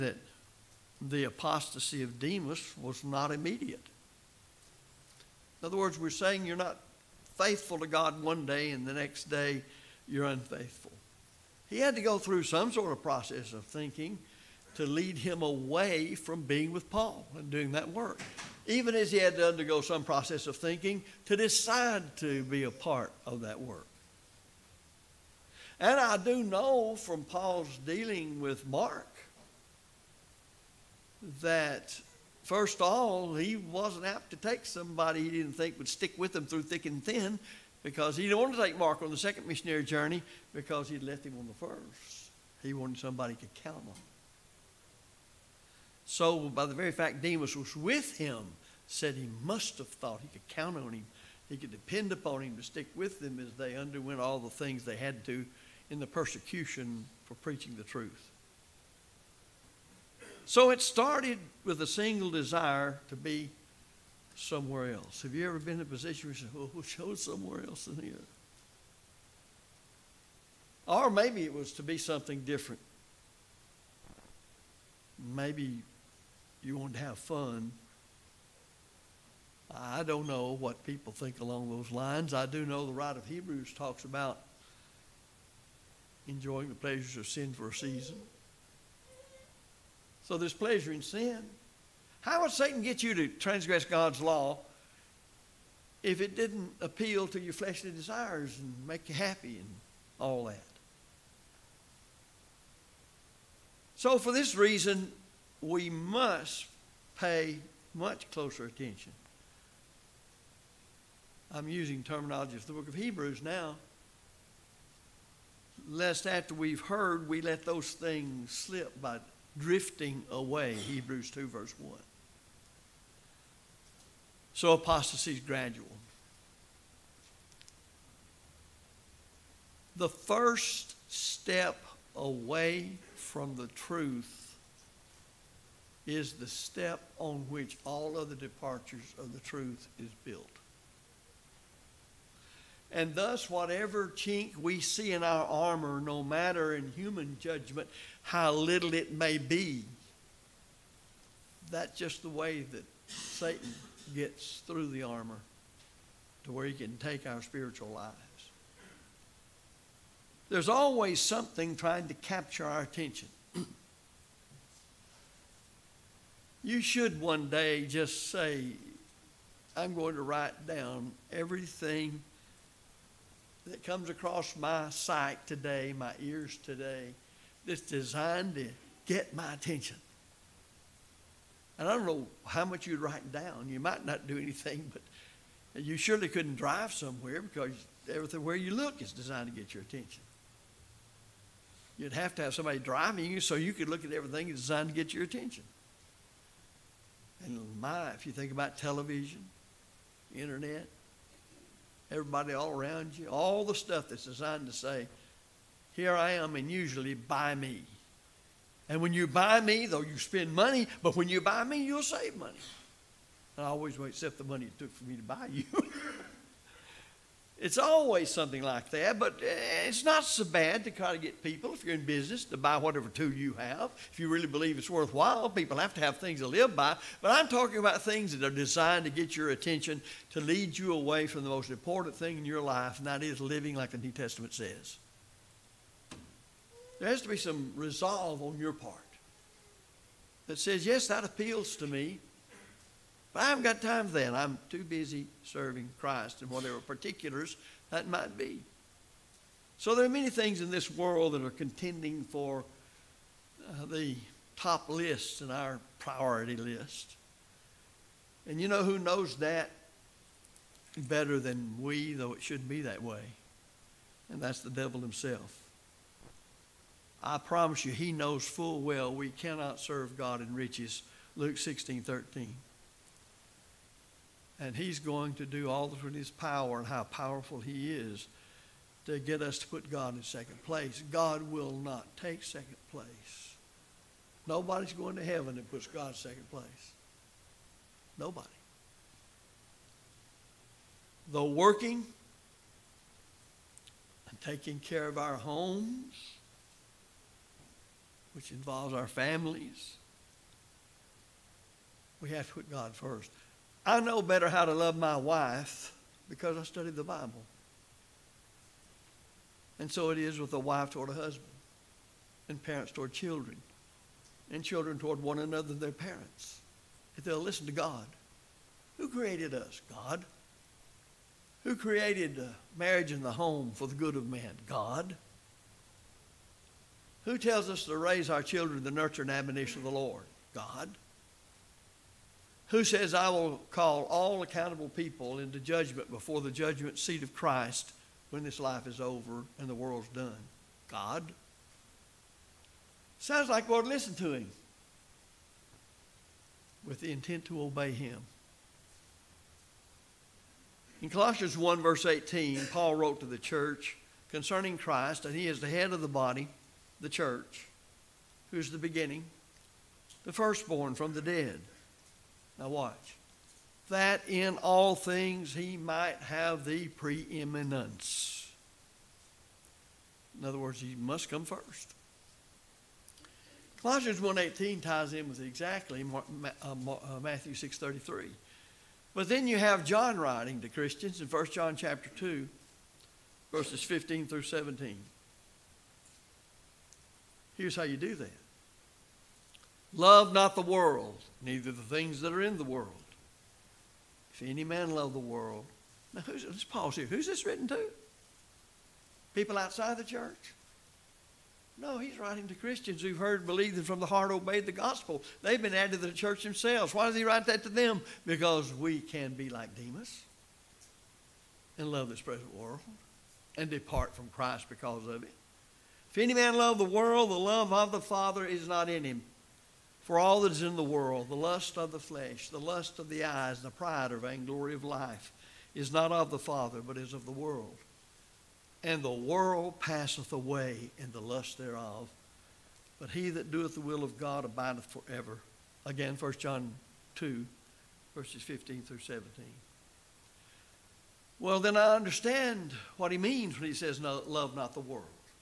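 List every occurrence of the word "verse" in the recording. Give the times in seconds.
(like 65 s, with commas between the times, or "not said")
121 s, 351 s, 383 s, 438 s.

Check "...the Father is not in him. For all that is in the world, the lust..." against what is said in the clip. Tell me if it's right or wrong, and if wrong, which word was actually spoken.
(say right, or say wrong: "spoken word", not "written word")
right.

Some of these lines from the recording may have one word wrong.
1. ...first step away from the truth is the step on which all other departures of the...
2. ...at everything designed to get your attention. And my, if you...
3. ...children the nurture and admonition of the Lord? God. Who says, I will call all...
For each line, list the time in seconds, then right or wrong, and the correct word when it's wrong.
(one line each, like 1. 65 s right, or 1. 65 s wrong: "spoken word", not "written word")
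1. 130 s right
2. 194 s right
3. 328 s right.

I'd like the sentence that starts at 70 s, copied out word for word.
Or maybe it was to be something different.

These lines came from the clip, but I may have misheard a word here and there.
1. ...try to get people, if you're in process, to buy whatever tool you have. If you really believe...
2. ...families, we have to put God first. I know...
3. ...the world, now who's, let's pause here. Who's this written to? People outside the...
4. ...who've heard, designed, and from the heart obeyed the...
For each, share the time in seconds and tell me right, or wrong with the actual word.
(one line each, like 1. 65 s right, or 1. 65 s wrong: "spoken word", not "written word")
1. 220 s wrong: "business", not "process"
2. 299 s right
3. 395 s right
4. 403 s wrong: "believed", not "designed".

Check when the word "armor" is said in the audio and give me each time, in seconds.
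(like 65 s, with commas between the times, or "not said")
145 s, 155 s.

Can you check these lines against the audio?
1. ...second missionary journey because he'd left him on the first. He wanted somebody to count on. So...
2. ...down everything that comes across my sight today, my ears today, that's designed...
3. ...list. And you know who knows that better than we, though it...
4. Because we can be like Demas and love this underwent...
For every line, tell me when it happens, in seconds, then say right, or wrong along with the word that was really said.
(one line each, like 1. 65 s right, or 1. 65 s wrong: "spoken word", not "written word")
1. 39 s right
2. 170 s right
3. 256 s right
4. 408 s wrong: "present", not "underwent".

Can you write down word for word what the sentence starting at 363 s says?
That in all things he might have the preeminence.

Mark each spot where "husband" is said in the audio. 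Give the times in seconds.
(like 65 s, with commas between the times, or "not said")
311 s.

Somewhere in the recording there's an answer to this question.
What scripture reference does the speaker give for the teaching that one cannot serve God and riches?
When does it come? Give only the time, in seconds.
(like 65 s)
271 s.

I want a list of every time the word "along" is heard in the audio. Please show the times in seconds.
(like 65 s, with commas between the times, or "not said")
81 s.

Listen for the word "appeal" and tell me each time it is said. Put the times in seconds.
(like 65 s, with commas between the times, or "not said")
96 s, 241 s.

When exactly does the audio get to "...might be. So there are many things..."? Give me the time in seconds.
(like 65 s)
248 s.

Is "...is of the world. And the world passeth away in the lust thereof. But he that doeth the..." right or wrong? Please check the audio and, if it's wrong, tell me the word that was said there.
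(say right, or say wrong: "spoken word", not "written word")
right.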